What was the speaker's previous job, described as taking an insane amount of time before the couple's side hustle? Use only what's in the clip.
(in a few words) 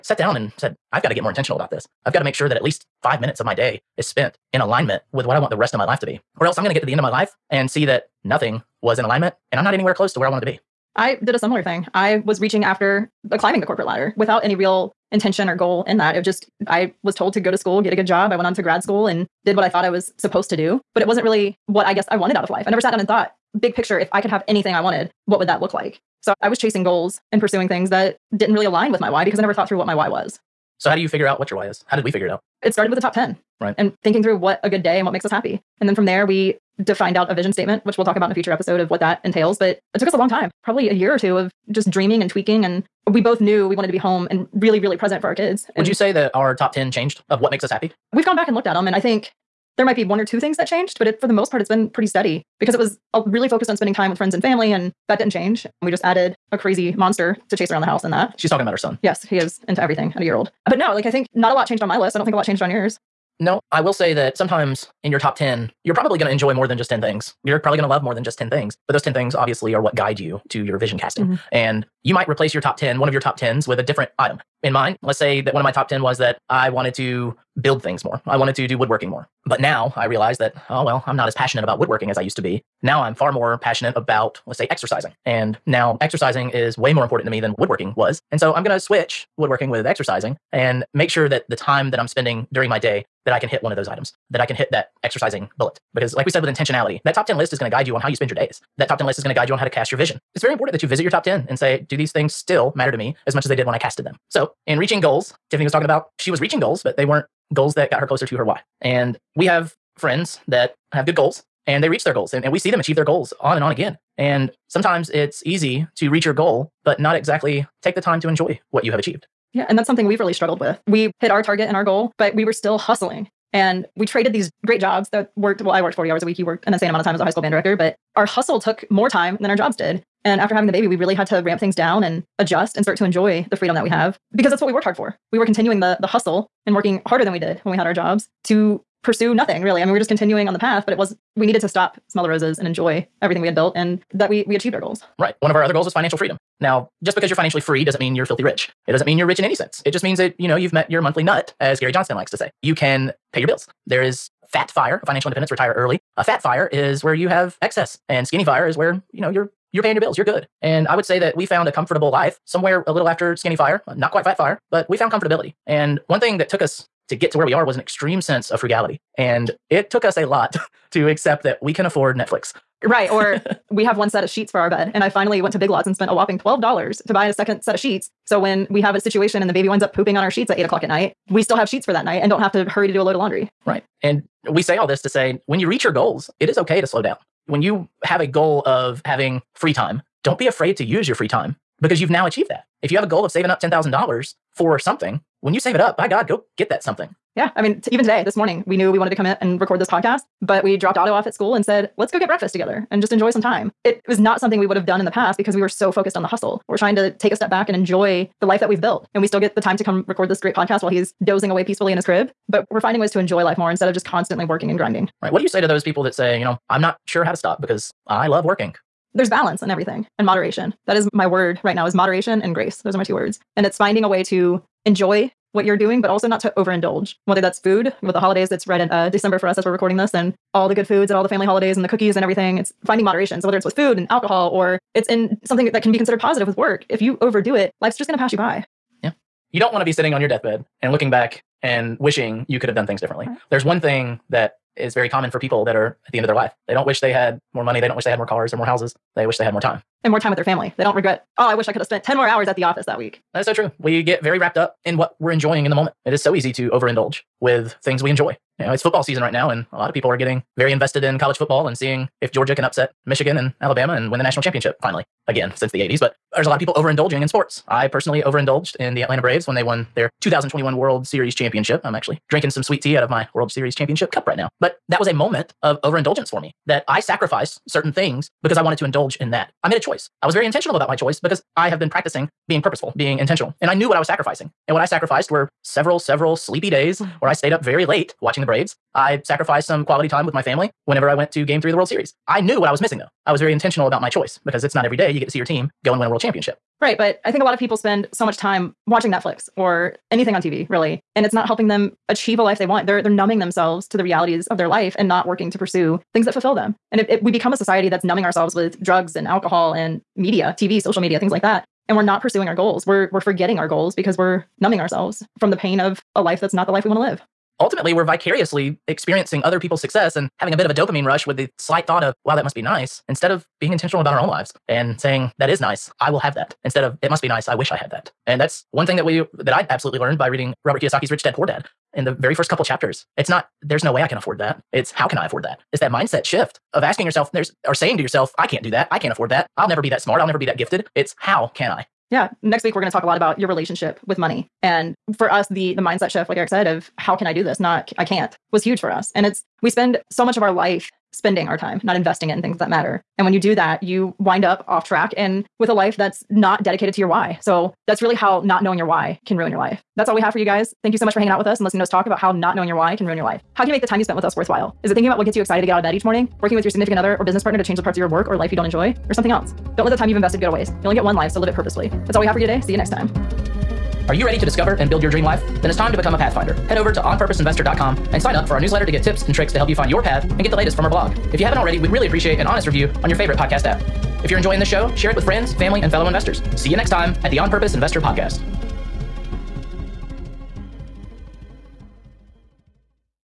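high school band director.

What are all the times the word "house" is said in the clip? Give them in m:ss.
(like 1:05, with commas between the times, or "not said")
0:57, 4:08.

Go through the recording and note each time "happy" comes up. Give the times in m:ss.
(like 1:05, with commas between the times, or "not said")
0:35, 0:47.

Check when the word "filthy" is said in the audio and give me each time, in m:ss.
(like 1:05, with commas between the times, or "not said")
2:28.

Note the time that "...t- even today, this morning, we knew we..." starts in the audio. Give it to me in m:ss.
3:17.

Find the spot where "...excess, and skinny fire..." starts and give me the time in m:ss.
2:37.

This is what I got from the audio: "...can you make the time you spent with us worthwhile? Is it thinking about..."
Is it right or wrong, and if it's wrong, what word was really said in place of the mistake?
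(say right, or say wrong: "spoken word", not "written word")
right.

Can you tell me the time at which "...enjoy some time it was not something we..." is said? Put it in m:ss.
3:23.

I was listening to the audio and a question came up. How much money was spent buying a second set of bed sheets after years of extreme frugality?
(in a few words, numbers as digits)
$12.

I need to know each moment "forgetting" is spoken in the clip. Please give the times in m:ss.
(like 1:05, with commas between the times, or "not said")
5:13.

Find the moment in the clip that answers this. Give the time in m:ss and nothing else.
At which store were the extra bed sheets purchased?
2:55.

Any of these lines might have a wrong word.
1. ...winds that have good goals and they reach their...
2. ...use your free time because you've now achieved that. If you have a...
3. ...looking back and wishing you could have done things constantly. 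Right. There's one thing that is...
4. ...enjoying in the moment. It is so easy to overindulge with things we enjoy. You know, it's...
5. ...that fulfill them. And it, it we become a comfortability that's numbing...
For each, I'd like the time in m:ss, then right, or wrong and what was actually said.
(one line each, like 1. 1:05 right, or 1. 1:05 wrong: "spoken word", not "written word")
1. 1:49 wrong: "friends", not "winds"
2. 3:10 right
3. 4:00 wrong: "differently", not "constantly"
4. 4:15 right
5. 5:06 wrong: "society", not "comfortability".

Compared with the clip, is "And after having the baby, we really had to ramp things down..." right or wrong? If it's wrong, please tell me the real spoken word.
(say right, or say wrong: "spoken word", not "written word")
right.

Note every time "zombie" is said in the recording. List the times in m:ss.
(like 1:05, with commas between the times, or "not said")
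not said.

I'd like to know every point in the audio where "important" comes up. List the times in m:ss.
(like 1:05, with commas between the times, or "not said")
1:27, 1:40.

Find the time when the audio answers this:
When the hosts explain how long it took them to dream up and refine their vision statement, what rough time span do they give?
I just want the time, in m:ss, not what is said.
0:40.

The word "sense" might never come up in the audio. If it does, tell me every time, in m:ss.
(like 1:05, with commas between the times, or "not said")
2:29, 2:48.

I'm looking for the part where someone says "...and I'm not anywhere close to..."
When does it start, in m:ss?
0:09.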